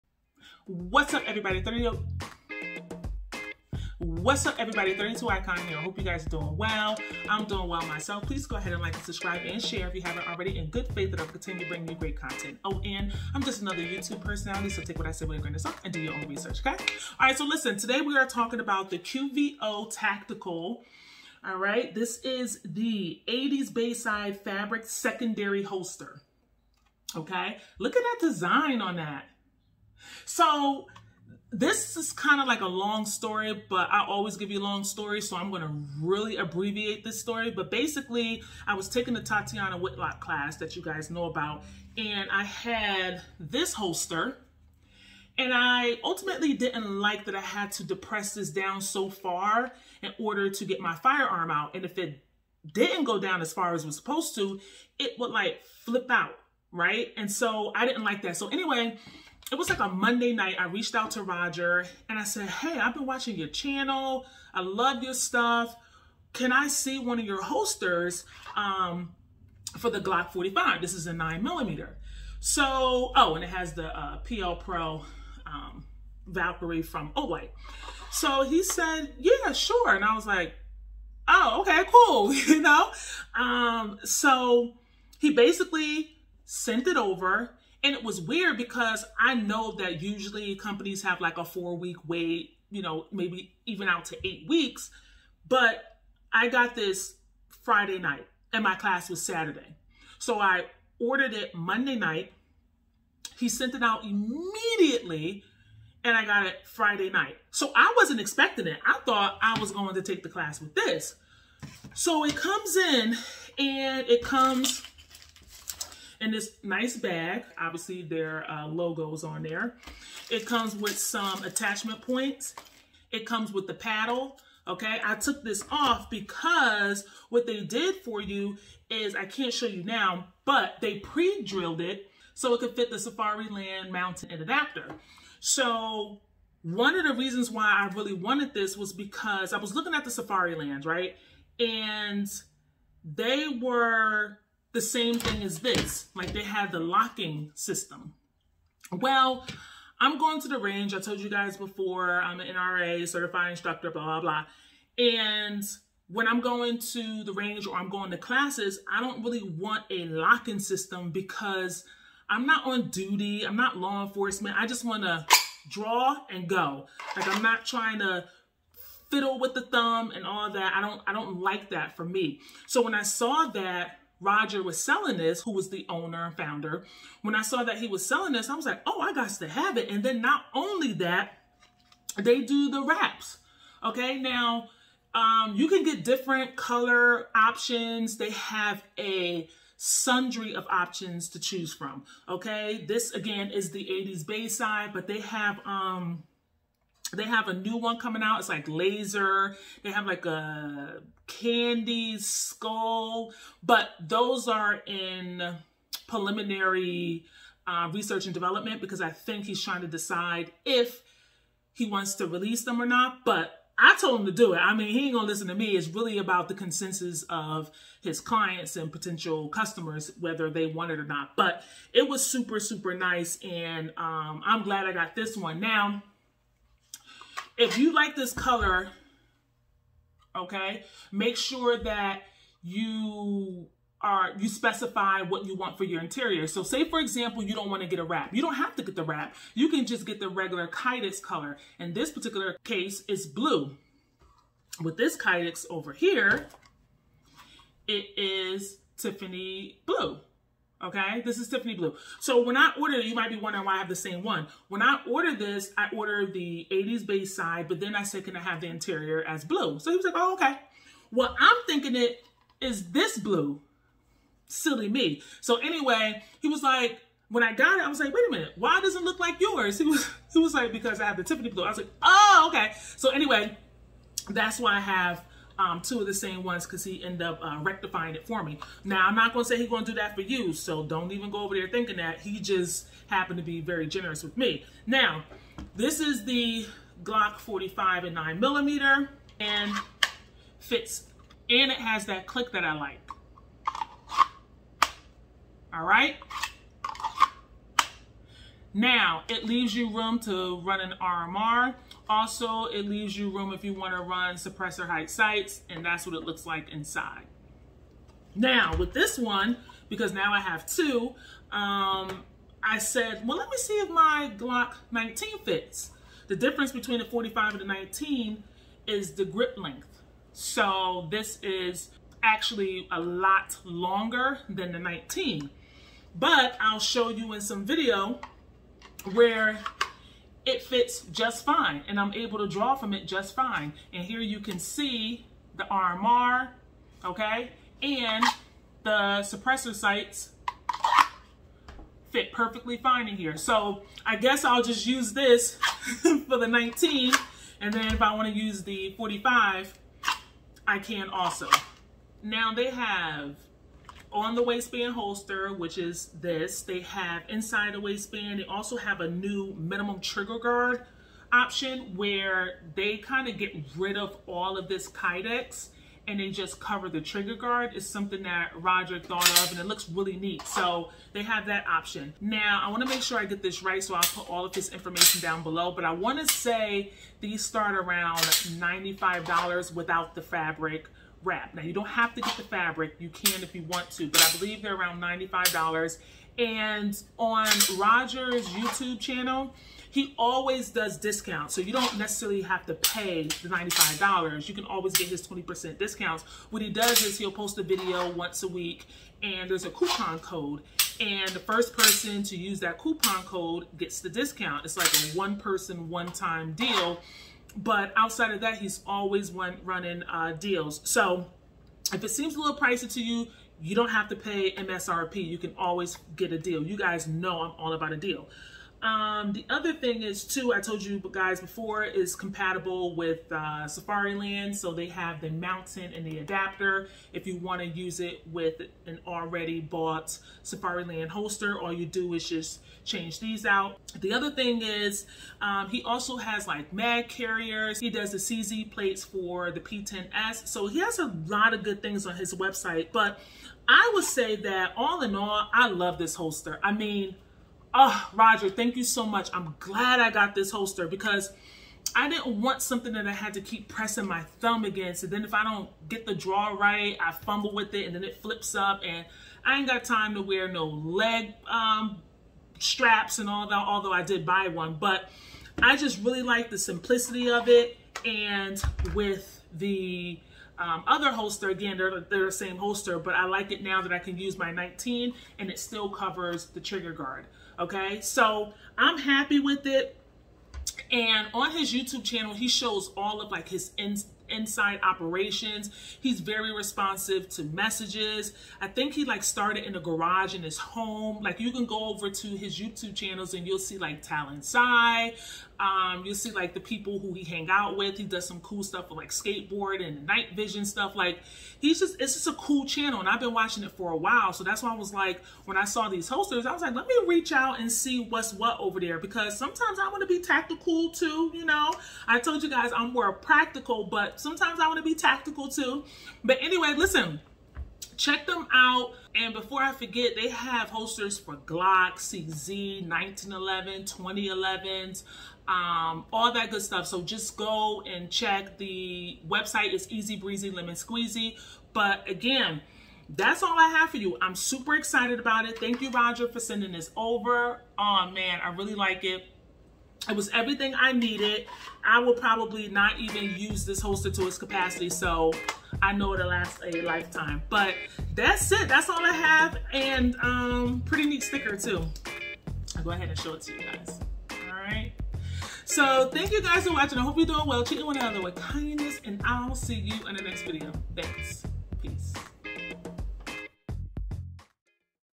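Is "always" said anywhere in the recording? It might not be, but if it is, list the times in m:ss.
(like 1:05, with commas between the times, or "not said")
0:34, 6:30, 6:34, 6:48, 6:55.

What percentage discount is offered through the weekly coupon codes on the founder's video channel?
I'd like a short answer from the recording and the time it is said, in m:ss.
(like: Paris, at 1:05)
20%, at 6:35.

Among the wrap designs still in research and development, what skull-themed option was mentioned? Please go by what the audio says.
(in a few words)
candy skull.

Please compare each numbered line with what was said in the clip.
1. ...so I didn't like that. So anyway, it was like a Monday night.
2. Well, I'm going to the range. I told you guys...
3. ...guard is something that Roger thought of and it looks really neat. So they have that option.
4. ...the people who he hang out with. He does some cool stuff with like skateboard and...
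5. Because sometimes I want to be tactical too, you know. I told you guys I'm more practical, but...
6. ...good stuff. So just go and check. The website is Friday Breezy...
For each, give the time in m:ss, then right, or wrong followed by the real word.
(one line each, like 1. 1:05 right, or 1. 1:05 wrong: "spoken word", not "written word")
1. 0:57 right
2. 2:28 right
3. 6:07 right
4. 8:16 right
5. 8:28 right
6. 8:46 wrong: "Easy", not "Friday".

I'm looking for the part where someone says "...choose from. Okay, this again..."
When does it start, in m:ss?
3:11.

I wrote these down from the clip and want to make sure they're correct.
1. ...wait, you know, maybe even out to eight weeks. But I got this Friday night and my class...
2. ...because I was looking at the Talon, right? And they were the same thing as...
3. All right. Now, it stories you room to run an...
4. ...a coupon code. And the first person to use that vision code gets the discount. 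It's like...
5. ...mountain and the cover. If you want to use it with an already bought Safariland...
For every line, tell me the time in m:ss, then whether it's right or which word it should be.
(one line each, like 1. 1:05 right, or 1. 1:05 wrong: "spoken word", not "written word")
1. 1:32 right
2. 2:18 wrong: "Safariland", not "Talon"
3. 4:55 wrong: "leaves", not "stories"
4. 6:39 wrong: "coupon", not "vision"
5. 7:05 wrong: "adapter", not "cover".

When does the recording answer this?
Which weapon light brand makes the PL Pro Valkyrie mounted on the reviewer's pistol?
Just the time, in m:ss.
1:17.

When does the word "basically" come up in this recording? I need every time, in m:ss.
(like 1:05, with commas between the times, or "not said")
0:37, 1:25.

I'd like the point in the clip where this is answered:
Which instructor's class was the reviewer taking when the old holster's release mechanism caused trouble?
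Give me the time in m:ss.
0:39.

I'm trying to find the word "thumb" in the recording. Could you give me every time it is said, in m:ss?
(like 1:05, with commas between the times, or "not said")
2:49, 7:34.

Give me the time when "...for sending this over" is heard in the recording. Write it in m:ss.
8:56.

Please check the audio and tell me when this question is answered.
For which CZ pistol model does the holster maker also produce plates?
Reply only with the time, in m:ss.
7:19.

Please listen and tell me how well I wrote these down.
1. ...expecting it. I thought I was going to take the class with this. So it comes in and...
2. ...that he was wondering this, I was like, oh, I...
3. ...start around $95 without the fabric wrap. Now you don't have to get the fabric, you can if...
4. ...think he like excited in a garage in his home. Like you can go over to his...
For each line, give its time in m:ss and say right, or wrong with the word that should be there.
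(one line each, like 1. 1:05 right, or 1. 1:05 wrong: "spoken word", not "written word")
1. 1:48 right
2. 2:57 wrong: "selling", not "wondering"
3. 6:17 right
4. 8:08 wrong: "started", not "excited".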